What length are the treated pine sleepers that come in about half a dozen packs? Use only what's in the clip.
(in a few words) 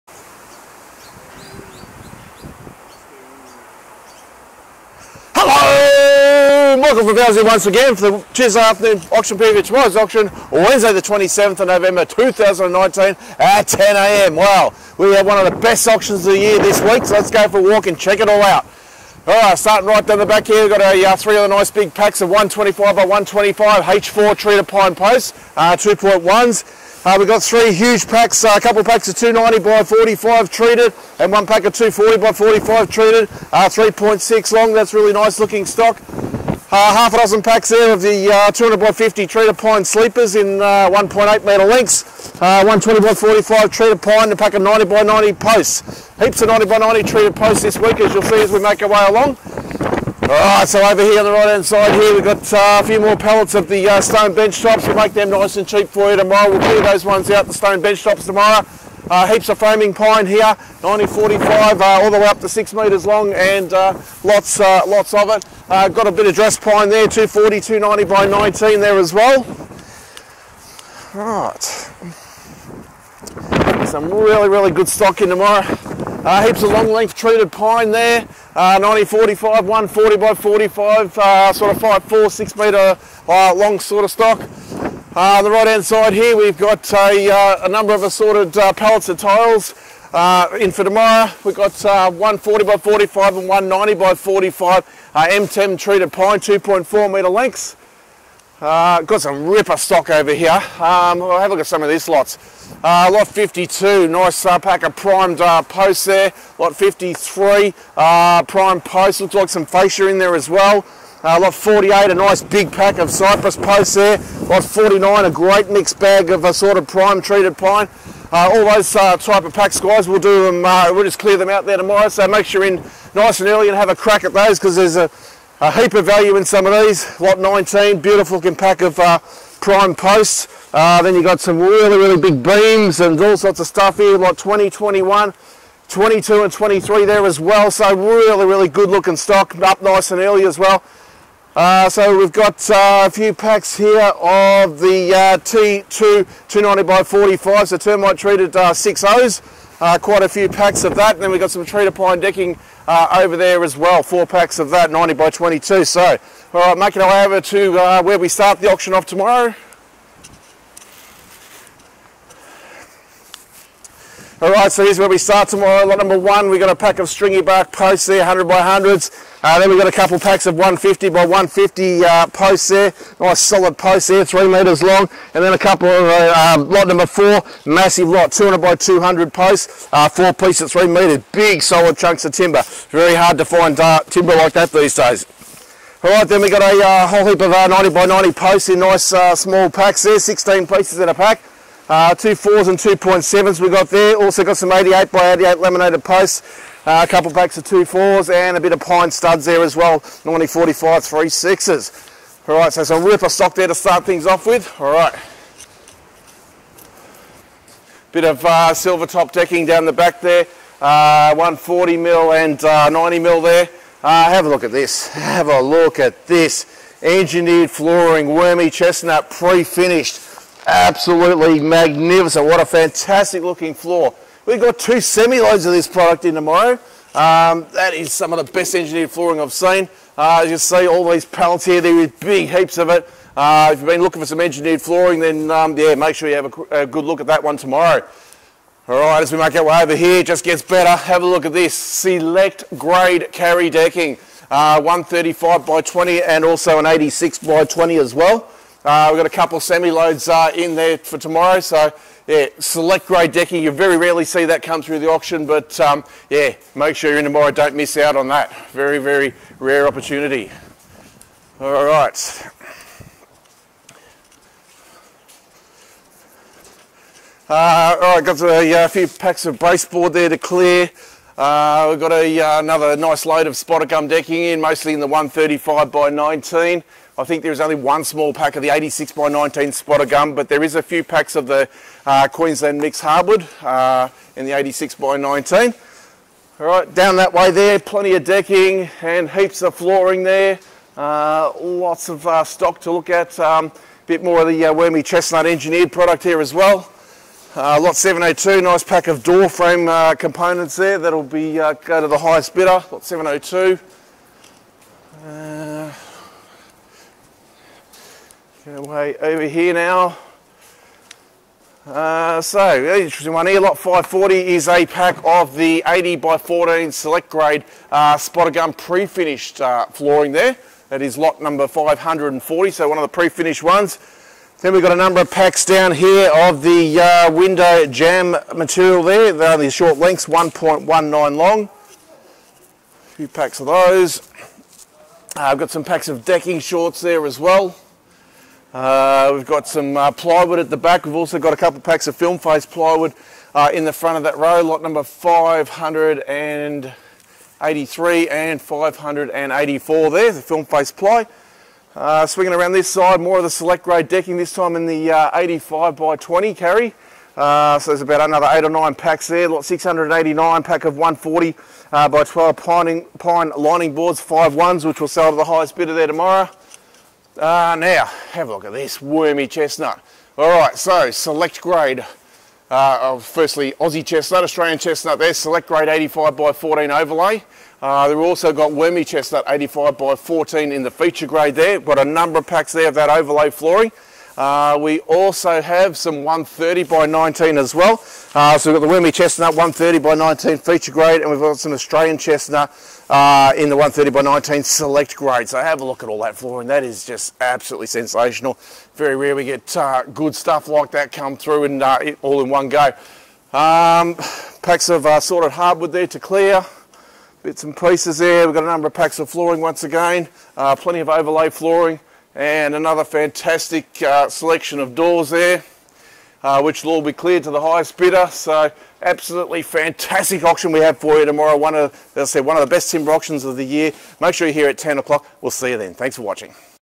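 1.8 metres.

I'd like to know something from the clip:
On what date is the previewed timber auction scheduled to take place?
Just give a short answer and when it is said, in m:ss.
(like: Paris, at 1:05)
27 November, at 0:11.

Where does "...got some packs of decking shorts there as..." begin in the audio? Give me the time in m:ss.
5:35.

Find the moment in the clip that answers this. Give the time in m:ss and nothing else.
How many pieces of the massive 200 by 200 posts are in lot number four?
3:00.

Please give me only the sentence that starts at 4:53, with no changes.
A um, bit more of the uh, wormy chestnut engineered product here as well.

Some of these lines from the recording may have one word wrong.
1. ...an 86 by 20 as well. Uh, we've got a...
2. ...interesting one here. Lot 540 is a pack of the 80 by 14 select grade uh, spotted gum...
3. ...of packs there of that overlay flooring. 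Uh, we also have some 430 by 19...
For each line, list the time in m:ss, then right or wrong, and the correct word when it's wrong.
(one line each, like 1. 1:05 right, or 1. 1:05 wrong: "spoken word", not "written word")
1. 4:06 right
2. 5:12 right
3. 6:22 wrong: "130", not "430".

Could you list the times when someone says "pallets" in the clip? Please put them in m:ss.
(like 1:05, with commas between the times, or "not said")
0:53, 1:28, 3:51.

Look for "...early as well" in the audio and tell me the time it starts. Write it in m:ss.
2:20.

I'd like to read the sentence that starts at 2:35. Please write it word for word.
So, all right, making our way over to uh, where we start the auction off tomorrow.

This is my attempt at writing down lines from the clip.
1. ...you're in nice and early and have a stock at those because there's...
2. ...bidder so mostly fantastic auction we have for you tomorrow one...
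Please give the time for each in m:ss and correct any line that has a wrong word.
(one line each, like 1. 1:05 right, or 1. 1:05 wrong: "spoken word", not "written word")
1. 2:02 wrong: "crack", not "stock"
2. 6:57 wrong: "absolutely", not "mostly".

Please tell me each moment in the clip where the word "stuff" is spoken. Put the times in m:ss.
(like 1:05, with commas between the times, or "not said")
2:13, 6:40.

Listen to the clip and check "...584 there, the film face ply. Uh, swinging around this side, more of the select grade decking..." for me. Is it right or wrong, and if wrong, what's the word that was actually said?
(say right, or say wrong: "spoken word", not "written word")
right.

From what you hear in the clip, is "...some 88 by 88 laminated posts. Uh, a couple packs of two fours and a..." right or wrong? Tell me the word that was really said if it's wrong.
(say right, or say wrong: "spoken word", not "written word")
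right.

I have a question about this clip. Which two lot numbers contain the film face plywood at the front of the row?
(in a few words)
583 and 584.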